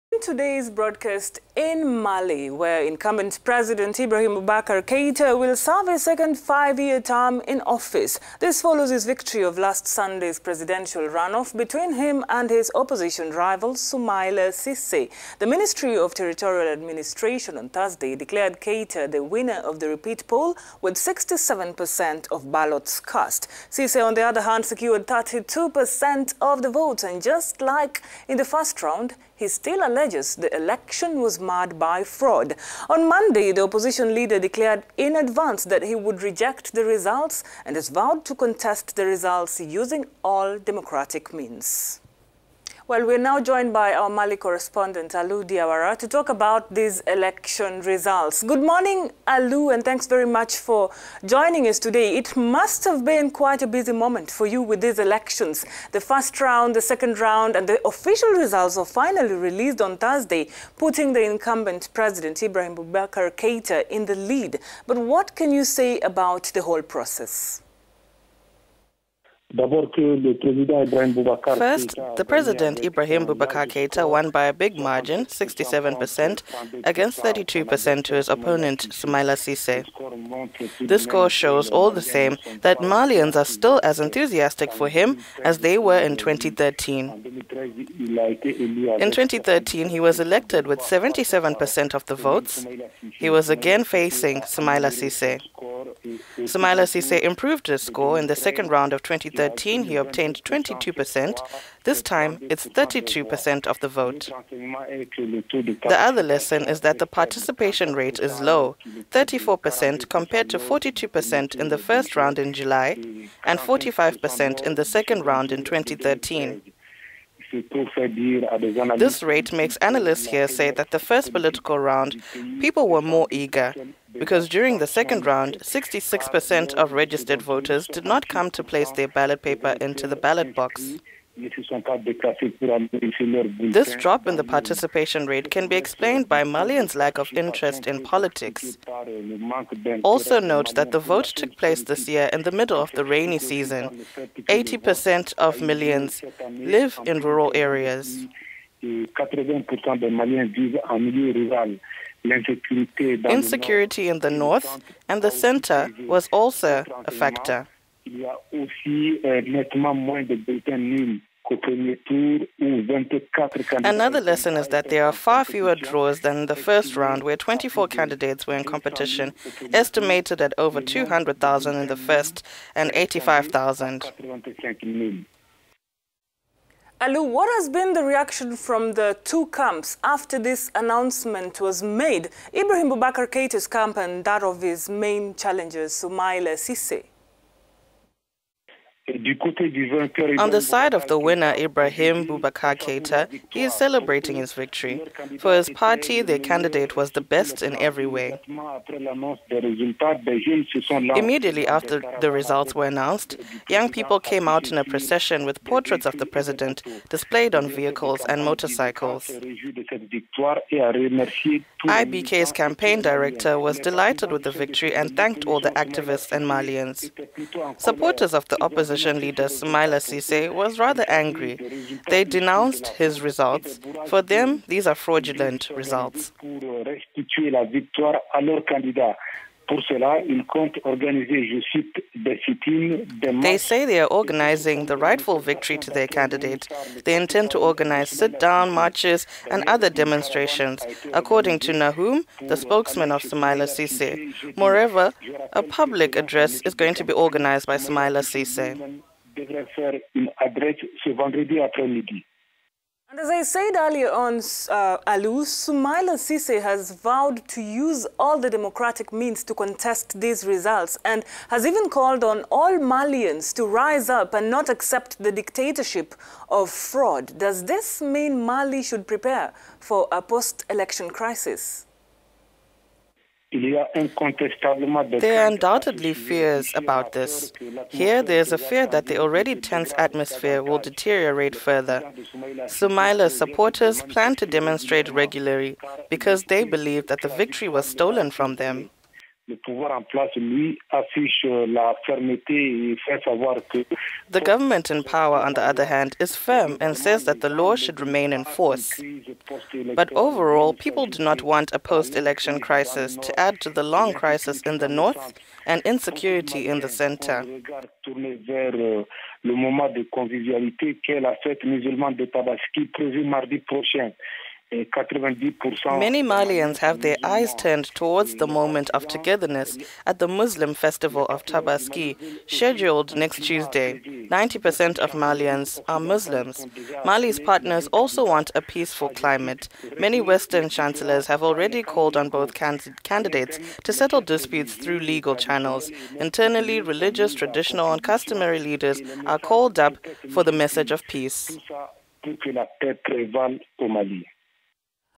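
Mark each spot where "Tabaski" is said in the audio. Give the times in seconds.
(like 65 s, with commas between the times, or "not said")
312 s, 321 s.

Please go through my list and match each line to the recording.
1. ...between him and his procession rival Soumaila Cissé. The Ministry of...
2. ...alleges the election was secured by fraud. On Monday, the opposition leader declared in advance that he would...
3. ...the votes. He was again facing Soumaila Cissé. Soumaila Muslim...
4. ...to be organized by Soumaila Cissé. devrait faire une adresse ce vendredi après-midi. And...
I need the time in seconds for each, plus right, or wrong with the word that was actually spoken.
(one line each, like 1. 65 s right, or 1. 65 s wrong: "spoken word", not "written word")
1. 11 s wrong: "opposition", not "procession"
2. 29 s wrong: "marred", not "secured"
3. 92 s wrong: "Cissé", not "Muslim"
4. 246 s right.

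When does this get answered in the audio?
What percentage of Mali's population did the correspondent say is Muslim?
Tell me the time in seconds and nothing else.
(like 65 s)
323 s.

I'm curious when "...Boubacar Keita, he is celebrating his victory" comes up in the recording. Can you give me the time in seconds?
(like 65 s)
192 s.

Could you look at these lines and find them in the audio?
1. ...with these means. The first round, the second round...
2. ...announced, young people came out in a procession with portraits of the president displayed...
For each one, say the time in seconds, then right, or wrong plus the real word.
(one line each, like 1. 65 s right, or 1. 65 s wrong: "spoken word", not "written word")
1. 54 s wrong: "elections", not "means"
2. 202 s right.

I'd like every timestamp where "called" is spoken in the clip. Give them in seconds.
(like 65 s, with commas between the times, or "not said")
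261 s, 331 s, 339 s.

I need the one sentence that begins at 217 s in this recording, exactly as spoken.
Supporters of the opposition opposition leader Soumaila Cissé was rather angry.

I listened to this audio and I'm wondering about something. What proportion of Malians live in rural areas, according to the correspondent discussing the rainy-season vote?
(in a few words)
80%.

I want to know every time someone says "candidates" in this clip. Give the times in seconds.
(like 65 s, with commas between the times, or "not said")
167 s, 196 s, 236 s, 333 s.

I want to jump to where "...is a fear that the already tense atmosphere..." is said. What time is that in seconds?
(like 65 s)
278 s.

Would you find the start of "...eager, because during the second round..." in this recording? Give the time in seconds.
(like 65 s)
123 s.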